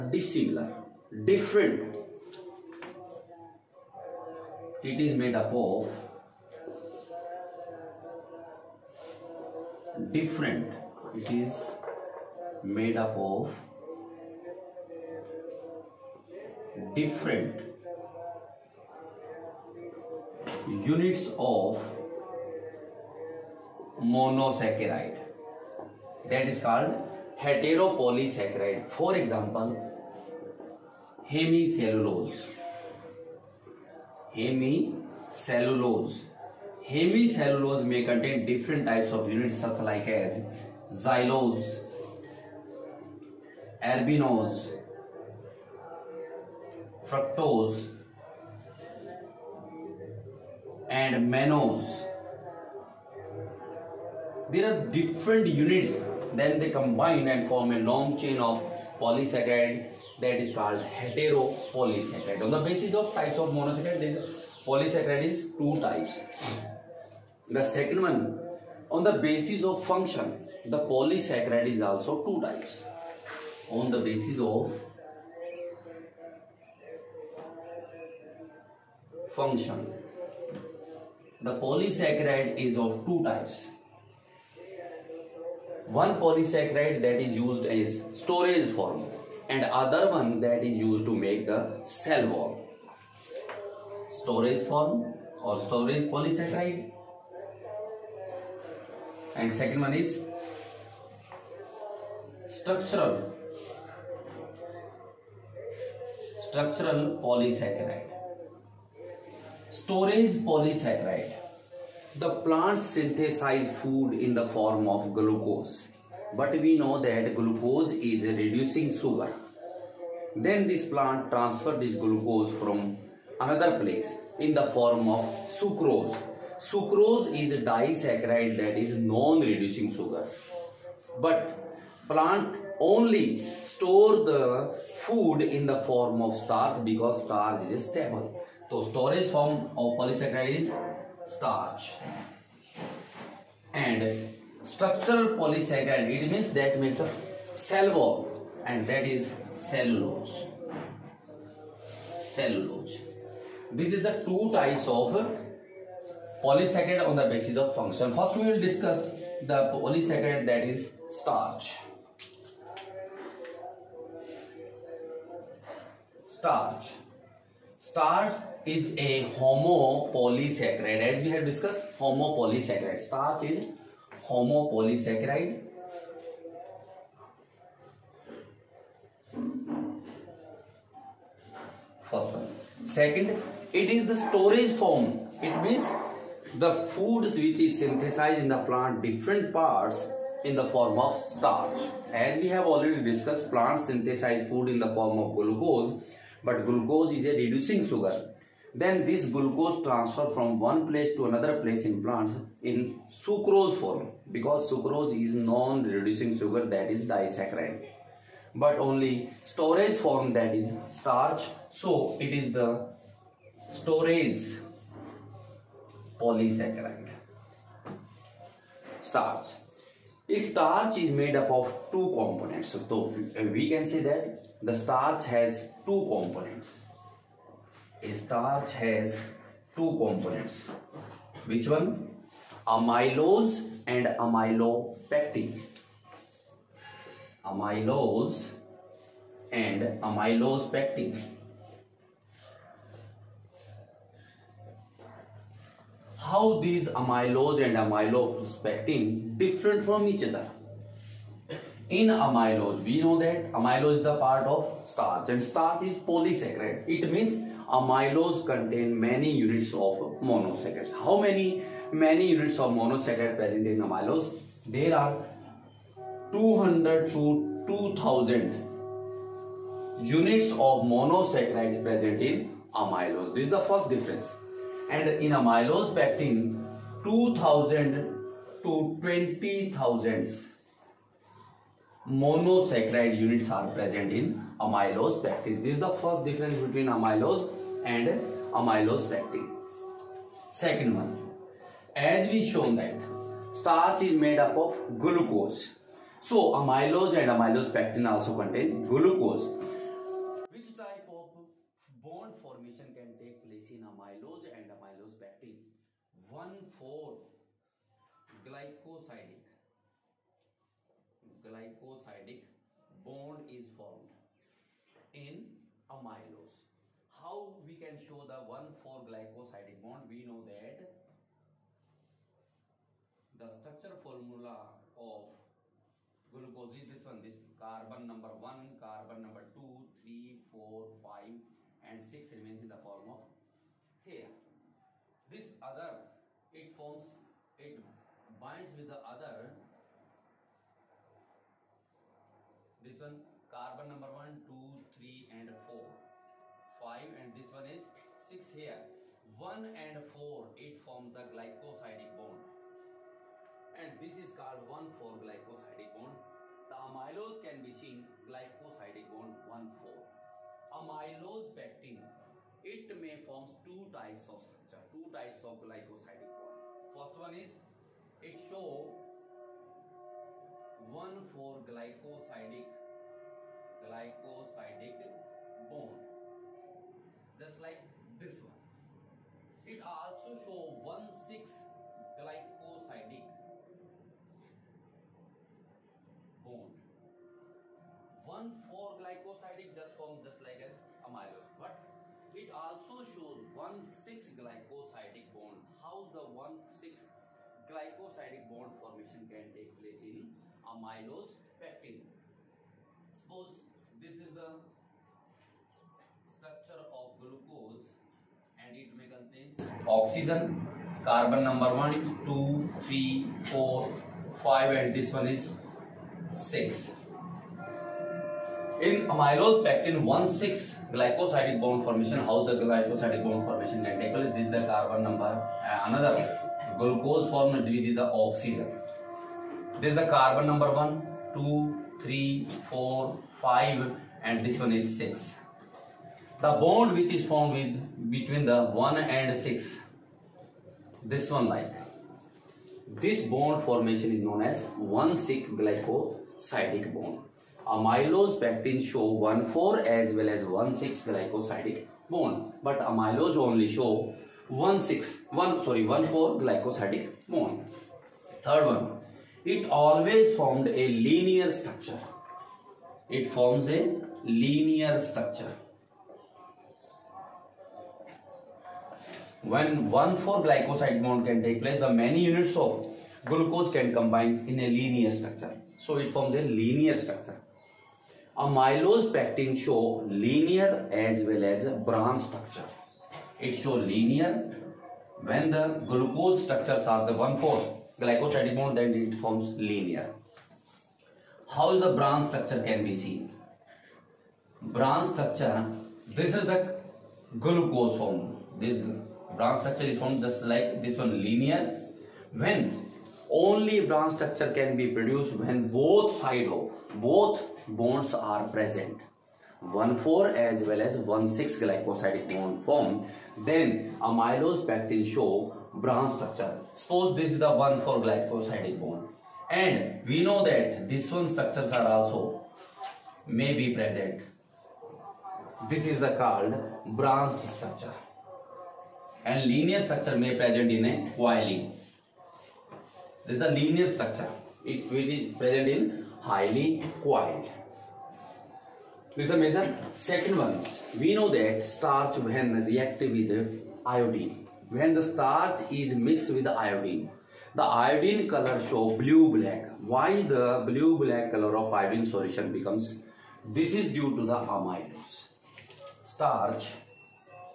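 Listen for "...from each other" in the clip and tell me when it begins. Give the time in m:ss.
4:09.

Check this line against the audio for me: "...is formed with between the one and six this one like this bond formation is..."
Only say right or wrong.
right.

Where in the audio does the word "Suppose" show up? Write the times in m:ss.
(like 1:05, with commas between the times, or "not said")
6:43, 8:36.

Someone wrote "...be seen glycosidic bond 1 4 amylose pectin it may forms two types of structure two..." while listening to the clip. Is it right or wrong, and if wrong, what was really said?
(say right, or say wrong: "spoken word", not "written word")
right.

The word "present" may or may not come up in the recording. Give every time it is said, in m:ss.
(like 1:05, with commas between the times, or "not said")
4:23, 4:31, 4:43, 8:28, 8:43, 8:50, 8:55.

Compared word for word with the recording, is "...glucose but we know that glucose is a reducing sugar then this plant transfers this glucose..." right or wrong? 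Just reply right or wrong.
right.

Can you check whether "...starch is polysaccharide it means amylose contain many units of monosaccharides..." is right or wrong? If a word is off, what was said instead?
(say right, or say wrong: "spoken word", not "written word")
right.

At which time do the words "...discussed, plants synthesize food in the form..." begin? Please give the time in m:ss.
3:13.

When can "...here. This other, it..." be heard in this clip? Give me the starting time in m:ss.
5:34.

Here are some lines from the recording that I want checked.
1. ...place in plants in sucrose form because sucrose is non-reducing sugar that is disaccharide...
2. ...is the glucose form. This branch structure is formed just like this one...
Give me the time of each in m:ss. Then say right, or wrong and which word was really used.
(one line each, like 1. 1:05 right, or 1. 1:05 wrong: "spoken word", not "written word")
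1. 3:21 right
2. 8:16 right.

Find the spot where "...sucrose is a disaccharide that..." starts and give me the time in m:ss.
2:06.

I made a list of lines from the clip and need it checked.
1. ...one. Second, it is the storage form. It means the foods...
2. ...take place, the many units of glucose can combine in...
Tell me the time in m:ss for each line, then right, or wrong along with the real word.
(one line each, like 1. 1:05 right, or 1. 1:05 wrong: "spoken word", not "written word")
1. 3:02 right
2. 7:51 right.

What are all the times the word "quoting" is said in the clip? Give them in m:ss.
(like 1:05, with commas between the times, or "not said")
not said.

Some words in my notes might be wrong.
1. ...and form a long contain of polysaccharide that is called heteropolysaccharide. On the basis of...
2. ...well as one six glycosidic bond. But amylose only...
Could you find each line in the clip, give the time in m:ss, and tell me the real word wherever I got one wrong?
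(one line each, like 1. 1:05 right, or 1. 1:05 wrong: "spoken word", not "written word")
1. 0:57 wrong: "chain", not "contain"
2. 7:30 right.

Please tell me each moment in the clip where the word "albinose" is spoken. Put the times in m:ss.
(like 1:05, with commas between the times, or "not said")
0:43.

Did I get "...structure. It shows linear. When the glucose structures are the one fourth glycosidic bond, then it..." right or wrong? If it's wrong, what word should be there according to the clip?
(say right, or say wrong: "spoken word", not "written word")
right.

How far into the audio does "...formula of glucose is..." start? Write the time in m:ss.
5:23.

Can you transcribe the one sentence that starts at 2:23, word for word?
And structural polysaccharide, it means that means the cell wall and that is cellulose.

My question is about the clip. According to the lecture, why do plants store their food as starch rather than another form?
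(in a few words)
Because starch is stable.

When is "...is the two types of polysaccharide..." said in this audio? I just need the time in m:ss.
2:33.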